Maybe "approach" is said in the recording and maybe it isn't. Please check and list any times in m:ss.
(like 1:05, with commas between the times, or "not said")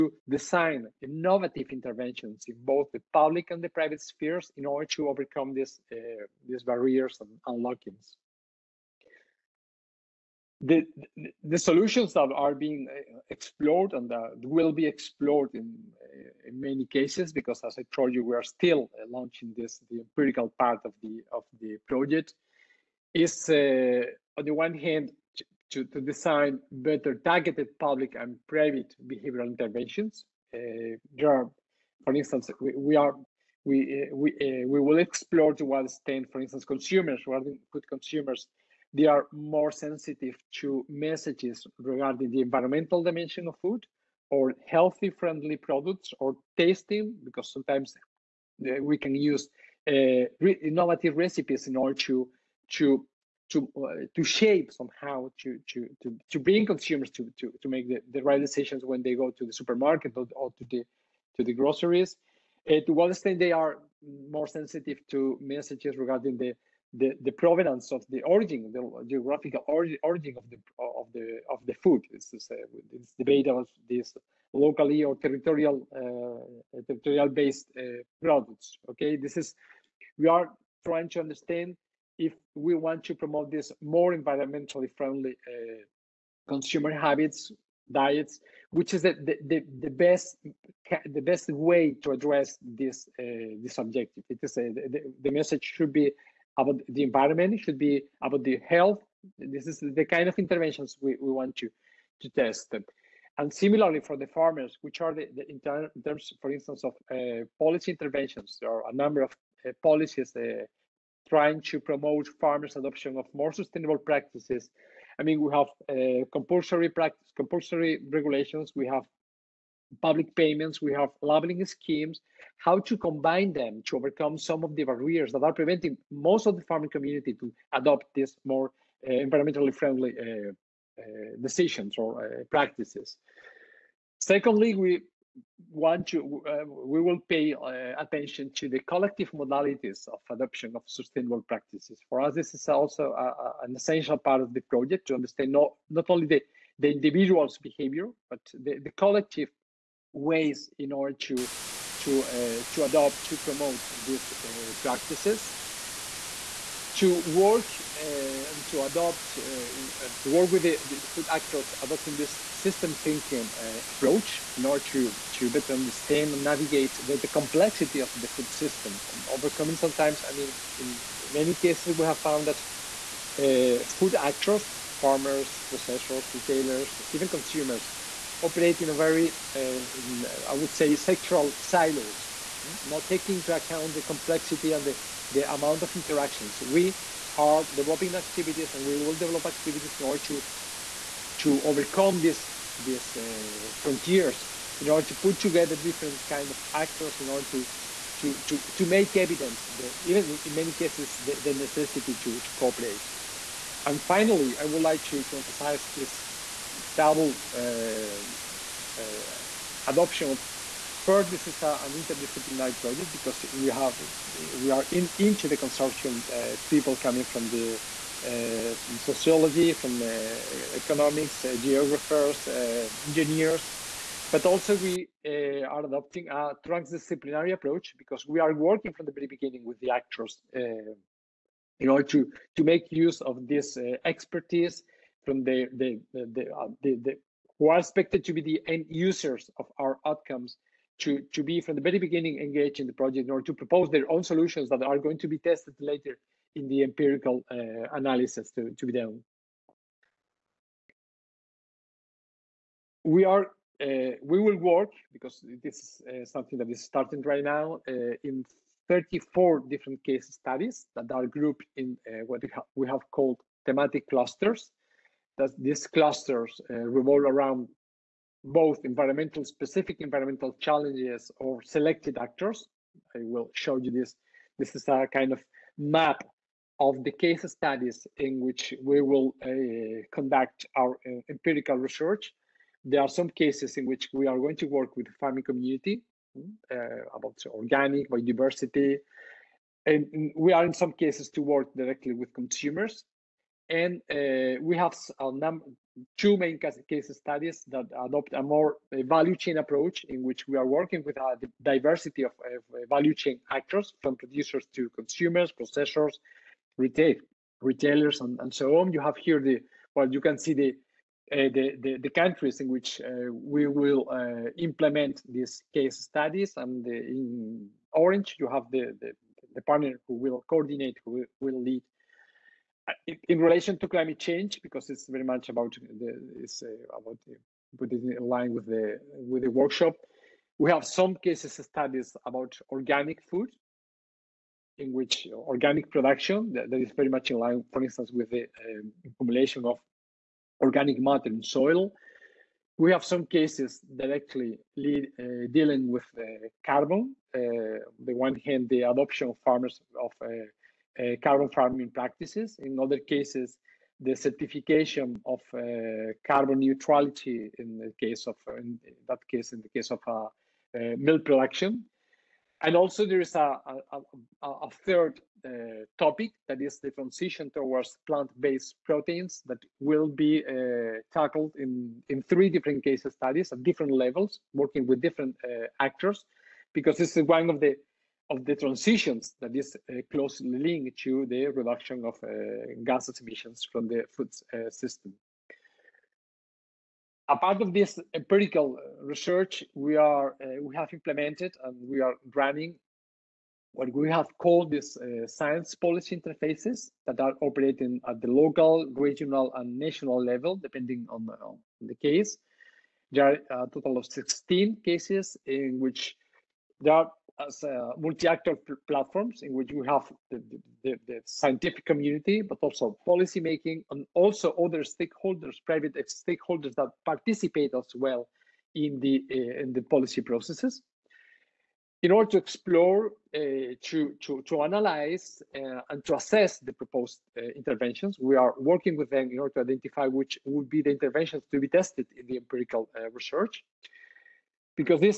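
2:43, 3:47, 4:59.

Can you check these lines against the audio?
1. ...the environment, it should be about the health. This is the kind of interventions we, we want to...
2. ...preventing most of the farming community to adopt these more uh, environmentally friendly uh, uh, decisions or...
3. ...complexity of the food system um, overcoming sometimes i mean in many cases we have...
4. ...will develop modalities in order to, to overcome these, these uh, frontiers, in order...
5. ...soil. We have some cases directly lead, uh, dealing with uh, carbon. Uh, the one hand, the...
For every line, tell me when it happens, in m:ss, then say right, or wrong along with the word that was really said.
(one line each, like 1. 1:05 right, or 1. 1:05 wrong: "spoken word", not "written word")
1. 1:36 right
2. 2:05 right
3. 2:47 right
4. 3:08 wrong: "activities", not "modalities"
5. 5:41 right.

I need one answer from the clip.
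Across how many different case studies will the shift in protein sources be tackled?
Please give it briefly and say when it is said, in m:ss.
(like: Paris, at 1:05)
3, at 6:12.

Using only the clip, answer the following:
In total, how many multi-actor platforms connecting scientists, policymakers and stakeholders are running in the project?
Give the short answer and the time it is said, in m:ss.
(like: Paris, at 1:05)
16, at 6:44.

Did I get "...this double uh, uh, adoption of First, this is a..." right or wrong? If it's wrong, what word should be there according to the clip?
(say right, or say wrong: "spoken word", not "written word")
right.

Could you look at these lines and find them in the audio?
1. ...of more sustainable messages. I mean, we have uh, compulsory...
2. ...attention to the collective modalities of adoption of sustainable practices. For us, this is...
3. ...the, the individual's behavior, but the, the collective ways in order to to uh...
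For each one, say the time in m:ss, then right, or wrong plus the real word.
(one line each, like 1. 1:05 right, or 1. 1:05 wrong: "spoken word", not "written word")
1. 1:53 wrong: "practices", not "messages"
2. 2:17 right
3. 2:26 right.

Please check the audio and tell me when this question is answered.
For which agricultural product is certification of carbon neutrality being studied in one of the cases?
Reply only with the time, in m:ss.
6:00.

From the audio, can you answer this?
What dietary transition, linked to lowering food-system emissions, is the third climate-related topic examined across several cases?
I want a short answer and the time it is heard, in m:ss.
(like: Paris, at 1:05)
plant-based proteins, at 6:08.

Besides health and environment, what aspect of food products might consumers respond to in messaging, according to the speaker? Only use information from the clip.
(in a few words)
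tasting.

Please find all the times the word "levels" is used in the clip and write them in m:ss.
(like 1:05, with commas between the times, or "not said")
6:13, 6:40.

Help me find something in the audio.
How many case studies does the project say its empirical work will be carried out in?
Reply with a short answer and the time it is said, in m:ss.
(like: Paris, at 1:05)
34, at 4:18.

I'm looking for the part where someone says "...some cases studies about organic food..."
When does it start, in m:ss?
5:30.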